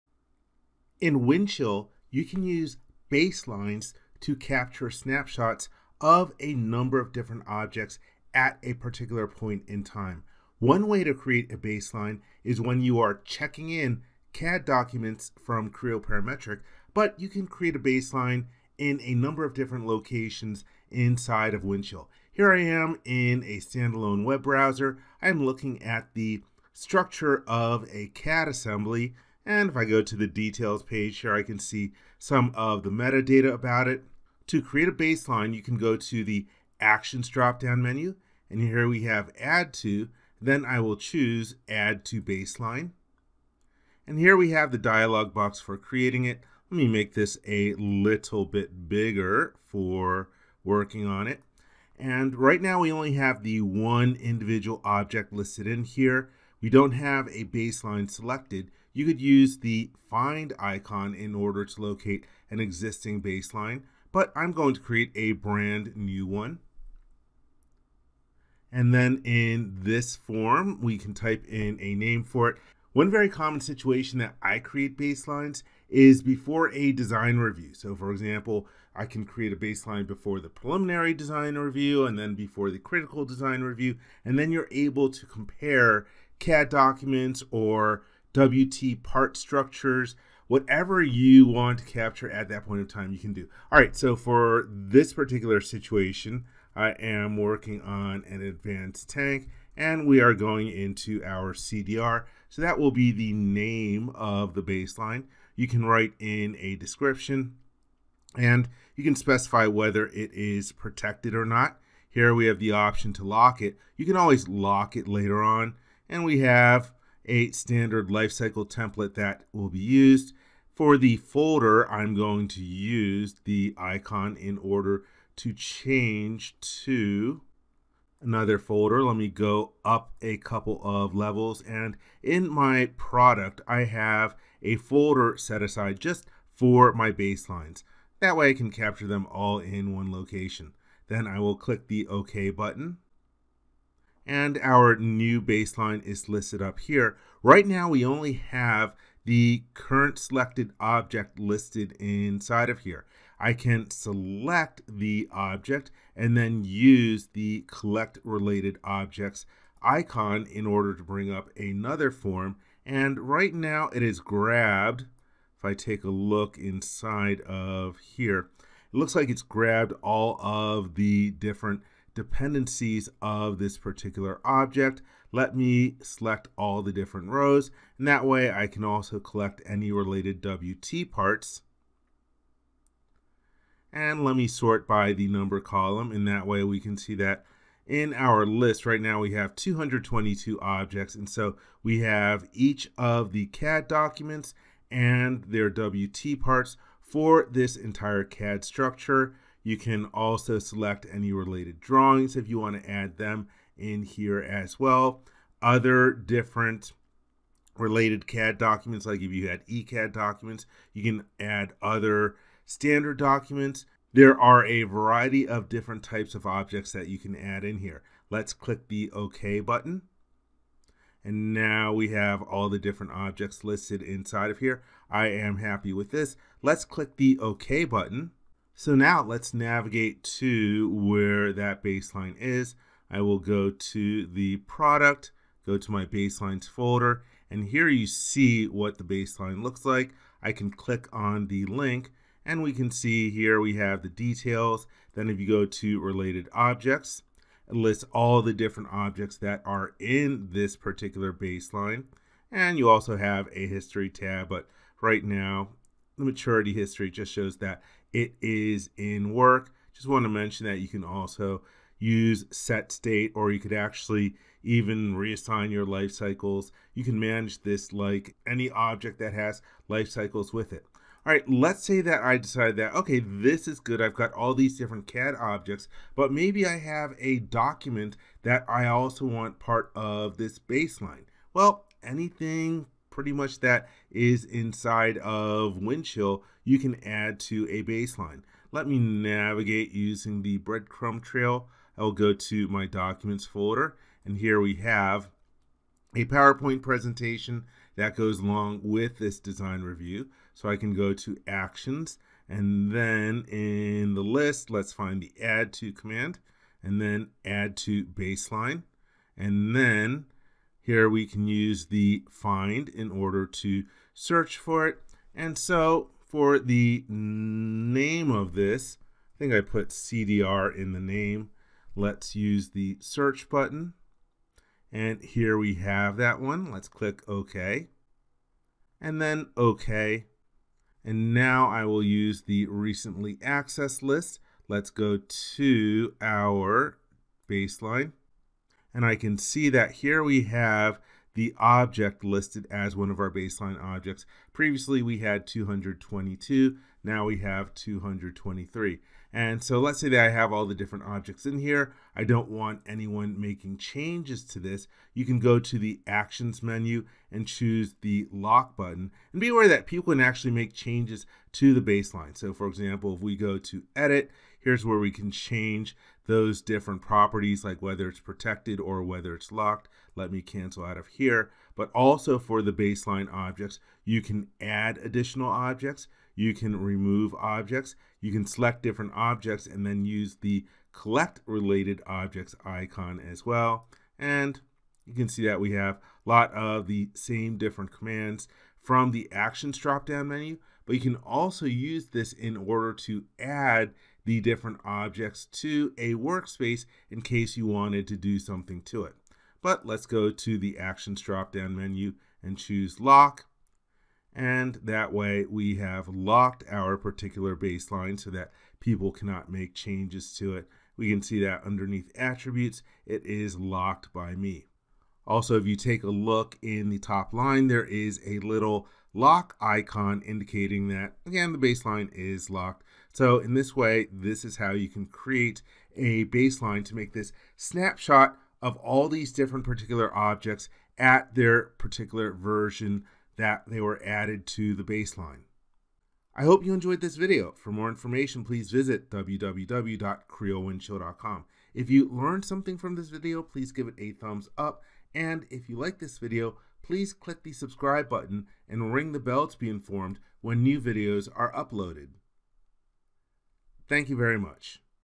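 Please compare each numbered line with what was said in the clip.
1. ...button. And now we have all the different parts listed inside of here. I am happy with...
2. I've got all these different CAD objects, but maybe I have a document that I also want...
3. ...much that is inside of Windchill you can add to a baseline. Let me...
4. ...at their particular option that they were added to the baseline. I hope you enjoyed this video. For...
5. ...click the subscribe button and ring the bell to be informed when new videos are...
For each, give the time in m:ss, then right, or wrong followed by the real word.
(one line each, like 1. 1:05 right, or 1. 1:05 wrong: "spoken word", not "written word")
1. 3:39 wrong: "objects", not "parts"
2. 4:34 right
3. 4:43 right
4. 7:10 wrong: "version", not "option"
5. 7:27 right.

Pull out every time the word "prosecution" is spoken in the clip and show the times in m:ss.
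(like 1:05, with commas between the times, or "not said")
not said.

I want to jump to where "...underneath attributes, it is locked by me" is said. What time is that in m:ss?
6:51.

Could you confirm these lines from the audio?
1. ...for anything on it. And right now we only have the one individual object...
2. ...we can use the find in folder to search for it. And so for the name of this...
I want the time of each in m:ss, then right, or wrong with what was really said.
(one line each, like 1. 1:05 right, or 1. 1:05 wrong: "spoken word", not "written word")
1. 0:49 wrong: "working", not "anything"
2. 5:11 wrong: "order", not "folder".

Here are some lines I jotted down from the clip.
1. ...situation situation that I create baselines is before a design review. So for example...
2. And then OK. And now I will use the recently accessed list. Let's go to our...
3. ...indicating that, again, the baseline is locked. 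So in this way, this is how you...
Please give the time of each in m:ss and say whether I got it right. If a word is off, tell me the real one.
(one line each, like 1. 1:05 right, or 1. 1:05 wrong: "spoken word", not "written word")
1. 1:13 wrong: "common", not "situation"
2. 5:28 right
3. 7:00 right.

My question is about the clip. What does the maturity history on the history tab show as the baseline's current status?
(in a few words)
in work.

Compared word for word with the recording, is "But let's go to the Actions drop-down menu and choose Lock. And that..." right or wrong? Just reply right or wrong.
right.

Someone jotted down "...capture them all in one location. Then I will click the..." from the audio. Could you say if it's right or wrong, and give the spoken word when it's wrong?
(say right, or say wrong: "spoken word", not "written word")
right.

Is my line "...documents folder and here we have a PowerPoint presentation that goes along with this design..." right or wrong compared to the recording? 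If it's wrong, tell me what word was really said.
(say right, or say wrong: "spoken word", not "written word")
right.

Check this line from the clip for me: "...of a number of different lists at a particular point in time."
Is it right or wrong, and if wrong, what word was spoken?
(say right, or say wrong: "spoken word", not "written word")
wrong: "objects", not "lists".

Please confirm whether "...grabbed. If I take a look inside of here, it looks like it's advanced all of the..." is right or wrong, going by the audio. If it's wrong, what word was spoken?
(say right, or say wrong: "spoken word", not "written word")
wrong: "grabbed", not "advanced".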